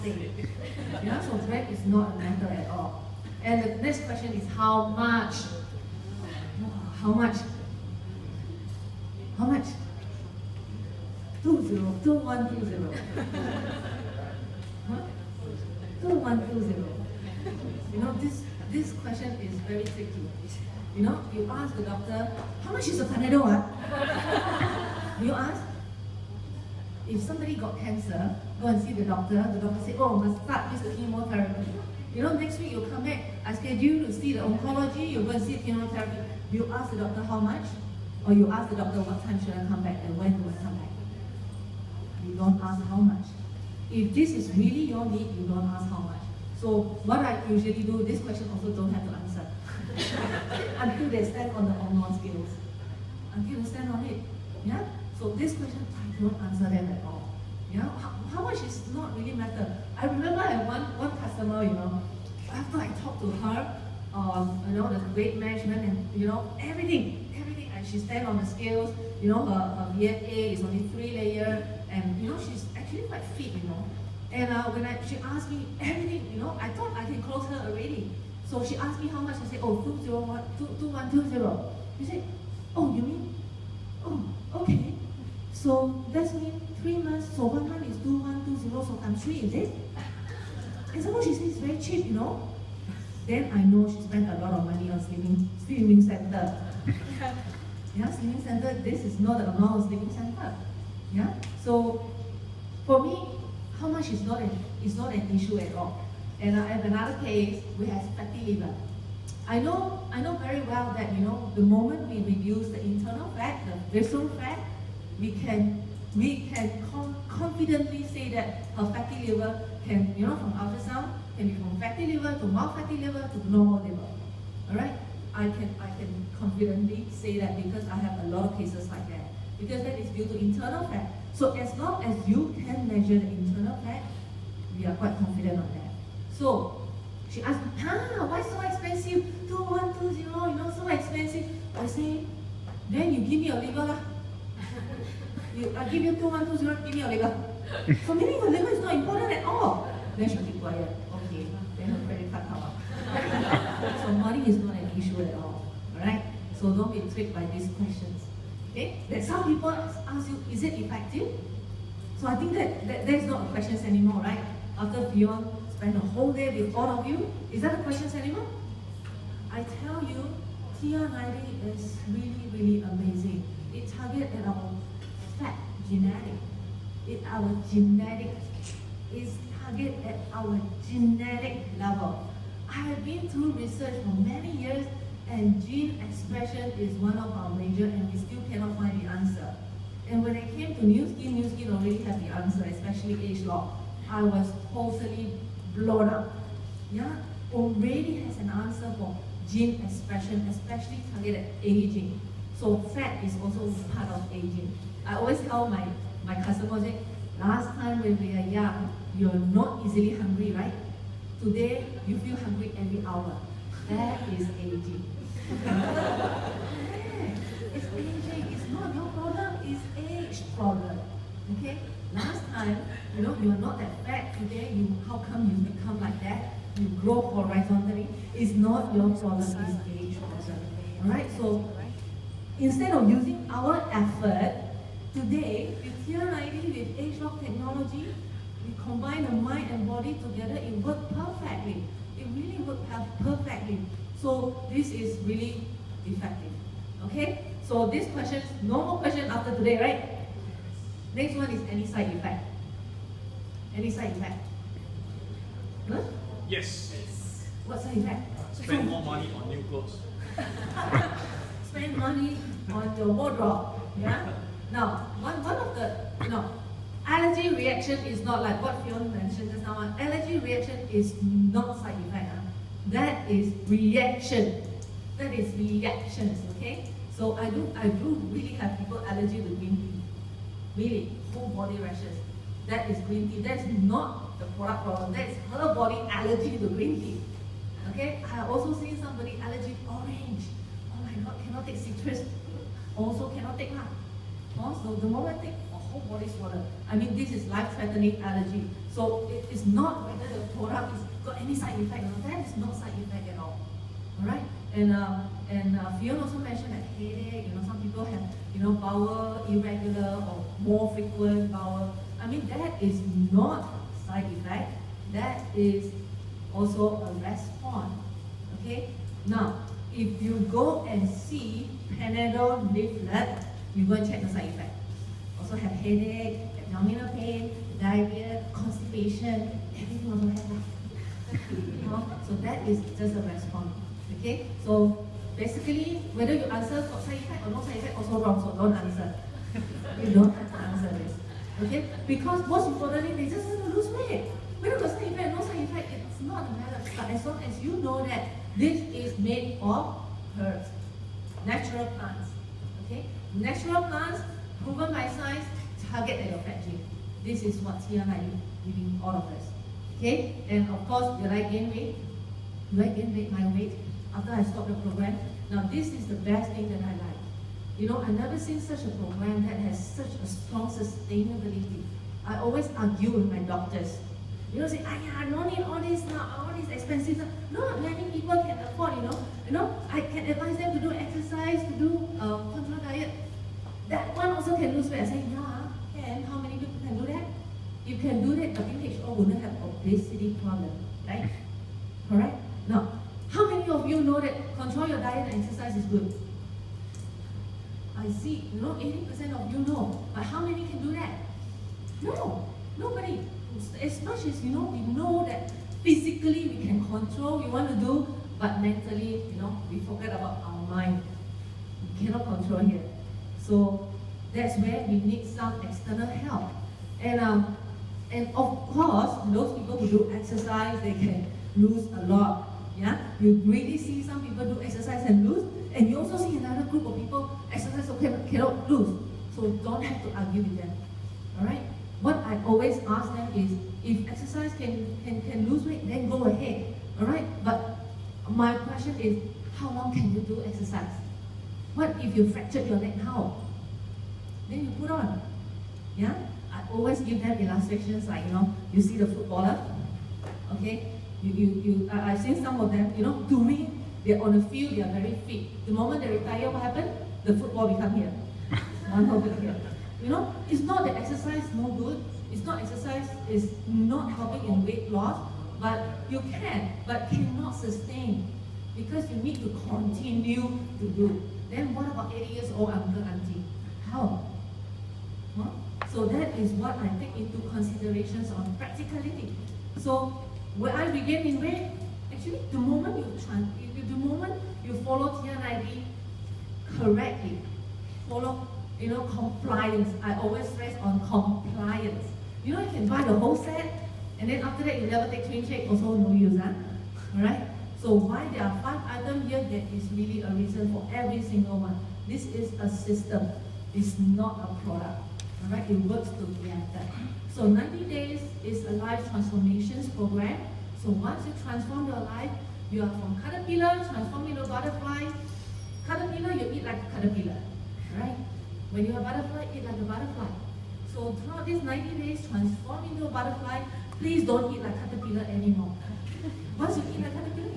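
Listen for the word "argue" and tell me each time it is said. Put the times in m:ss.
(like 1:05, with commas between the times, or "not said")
6:12, 7:10.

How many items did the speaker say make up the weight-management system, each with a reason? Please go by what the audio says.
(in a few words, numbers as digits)
5.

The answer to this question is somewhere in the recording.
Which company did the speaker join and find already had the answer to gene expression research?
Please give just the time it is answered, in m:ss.
3:11.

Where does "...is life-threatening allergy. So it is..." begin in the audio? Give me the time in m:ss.
4:57.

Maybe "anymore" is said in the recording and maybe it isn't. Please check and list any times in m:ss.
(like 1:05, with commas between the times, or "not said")
2:43, 8:45.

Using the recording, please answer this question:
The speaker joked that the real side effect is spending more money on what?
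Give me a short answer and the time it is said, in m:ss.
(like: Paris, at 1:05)
new clothes, at 4:18.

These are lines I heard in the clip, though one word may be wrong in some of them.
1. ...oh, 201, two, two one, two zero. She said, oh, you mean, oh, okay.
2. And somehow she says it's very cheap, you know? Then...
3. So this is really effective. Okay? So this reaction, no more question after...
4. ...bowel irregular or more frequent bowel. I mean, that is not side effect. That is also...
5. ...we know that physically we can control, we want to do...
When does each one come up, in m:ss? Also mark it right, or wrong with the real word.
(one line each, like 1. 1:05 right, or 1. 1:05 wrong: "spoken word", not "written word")
1. 1:19 right
2. 1:30 right
3. 4:04 wrong: "question", not "reaction"
4. 5:08 right
5. 6:44 right.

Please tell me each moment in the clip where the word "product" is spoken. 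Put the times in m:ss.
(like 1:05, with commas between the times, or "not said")
4:44, 5:00, 8:24.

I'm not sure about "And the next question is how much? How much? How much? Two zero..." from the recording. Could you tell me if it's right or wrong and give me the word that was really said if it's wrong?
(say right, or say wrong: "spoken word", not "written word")
right.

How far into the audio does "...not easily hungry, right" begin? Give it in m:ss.
3:29.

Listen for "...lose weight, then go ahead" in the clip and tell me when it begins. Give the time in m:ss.
7:15.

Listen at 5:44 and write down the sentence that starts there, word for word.
Whether got side effect or no side effect, it's not a matter.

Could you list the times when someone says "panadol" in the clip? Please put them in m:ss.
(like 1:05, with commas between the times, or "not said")
0:23, 5:21.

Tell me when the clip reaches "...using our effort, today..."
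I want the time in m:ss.
3:53.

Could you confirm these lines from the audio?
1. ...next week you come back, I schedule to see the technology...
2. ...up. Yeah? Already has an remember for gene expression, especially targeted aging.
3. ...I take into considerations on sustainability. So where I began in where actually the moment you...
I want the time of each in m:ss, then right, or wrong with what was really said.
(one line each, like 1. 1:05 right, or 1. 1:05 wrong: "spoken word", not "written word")
1. 0:32 wrong: "oncology", not "technology"
2. 3:16 wrong: "answer", not "remember"
3. 7:56 wrong: "practicality", not "sustainability".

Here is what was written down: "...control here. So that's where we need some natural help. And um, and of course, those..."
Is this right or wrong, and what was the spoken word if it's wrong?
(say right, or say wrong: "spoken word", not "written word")
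wrong: "external", not "natural".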